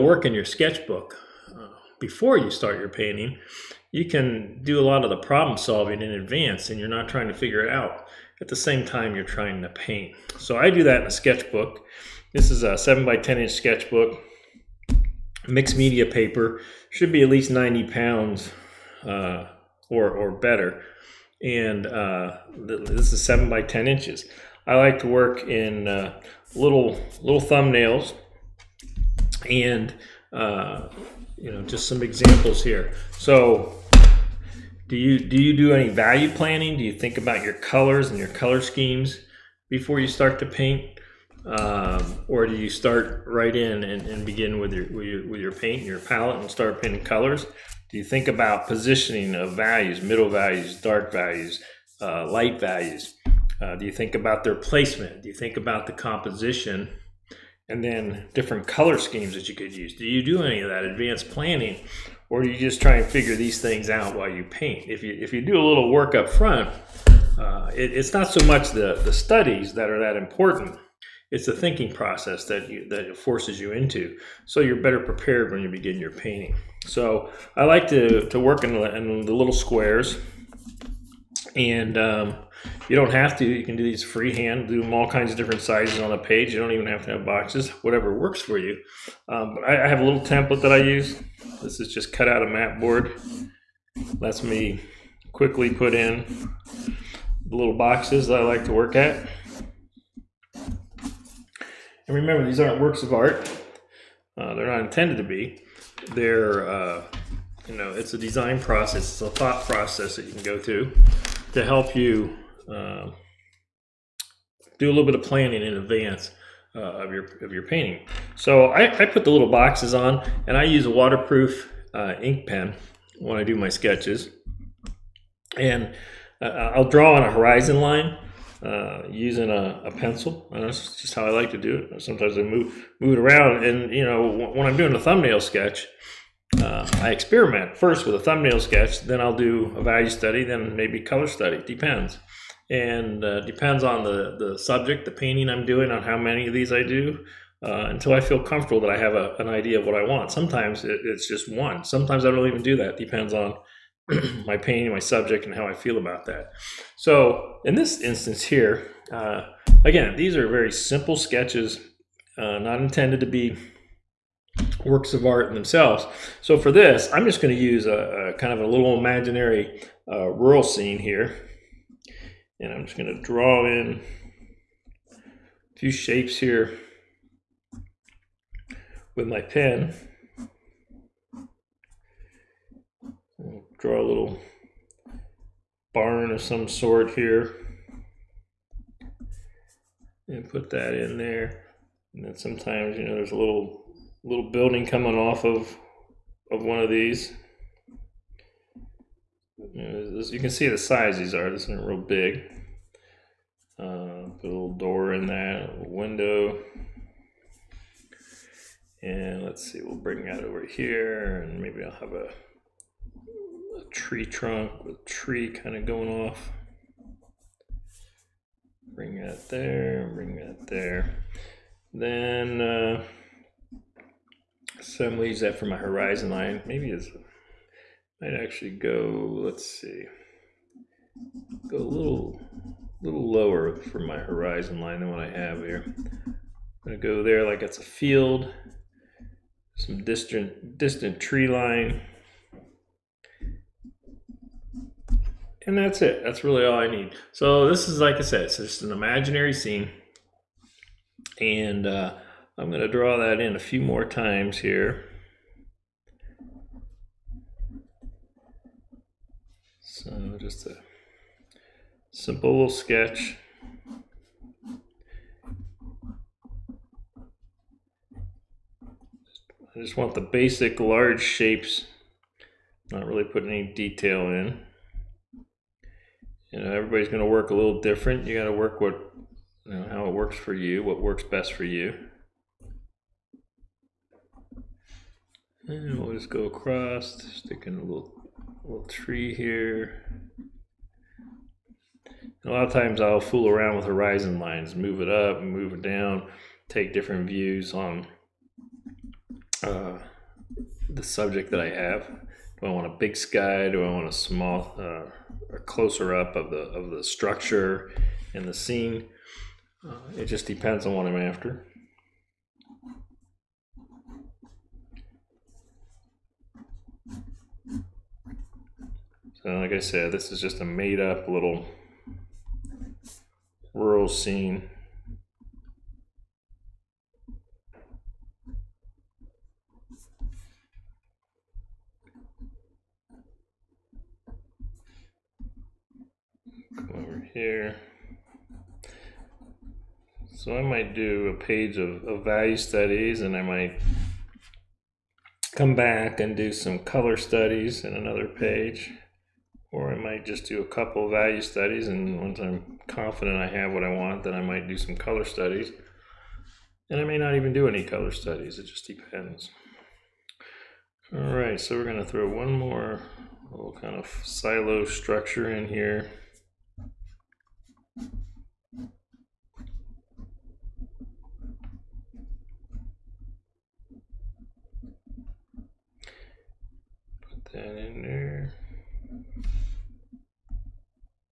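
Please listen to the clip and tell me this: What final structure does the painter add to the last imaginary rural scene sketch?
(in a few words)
silo.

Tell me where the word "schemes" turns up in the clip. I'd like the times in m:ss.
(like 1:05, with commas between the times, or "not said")
0:38, 0:58.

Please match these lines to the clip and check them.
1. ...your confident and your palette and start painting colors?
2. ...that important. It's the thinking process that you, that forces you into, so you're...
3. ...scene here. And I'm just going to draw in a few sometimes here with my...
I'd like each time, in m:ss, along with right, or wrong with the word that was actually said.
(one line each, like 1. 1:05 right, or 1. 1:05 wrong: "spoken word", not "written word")
1. 0:45 wrong: "paint", not "confident"
2. 1:09 right
3. 2:50 wrong: "shapes", not "sometimes".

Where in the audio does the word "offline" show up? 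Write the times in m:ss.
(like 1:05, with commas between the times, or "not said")
not said.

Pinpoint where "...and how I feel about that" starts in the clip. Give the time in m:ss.
2:35.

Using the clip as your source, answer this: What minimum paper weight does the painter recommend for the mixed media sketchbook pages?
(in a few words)
90 pounds.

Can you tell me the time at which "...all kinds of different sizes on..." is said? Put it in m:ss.
1:24.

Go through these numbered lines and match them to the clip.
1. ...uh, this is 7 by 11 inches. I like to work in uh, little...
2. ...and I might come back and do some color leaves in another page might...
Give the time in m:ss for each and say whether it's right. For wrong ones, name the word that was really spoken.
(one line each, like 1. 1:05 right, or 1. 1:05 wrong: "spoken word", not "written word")
1. 0:21 wrong: "10", not "11"
2. 5:43 wrong: "studies", not "leaves".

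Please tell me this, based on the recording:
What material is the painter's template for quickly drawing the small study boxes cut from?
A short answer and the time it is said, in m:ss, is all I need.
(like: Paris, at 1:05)
map board, at 1:32.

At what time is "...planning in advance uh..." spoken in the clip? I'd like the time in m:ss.
1:55.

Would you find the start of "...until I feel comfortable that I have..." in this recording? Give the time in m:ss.
2:27.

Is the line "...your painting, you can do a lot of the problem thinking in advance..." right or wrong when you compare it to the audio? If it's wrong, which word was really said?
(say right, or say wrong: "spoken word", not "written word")
wrong: "solving", not "thinking".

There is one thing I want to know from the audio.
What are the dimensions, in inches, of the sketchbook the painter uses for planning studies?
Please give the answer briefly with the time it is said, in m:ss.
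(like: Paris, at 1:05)
7 by 10 inches, at 0:12.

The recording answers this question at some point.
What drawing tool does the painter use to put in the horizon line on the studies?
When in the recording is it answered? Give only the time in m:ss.
2:09.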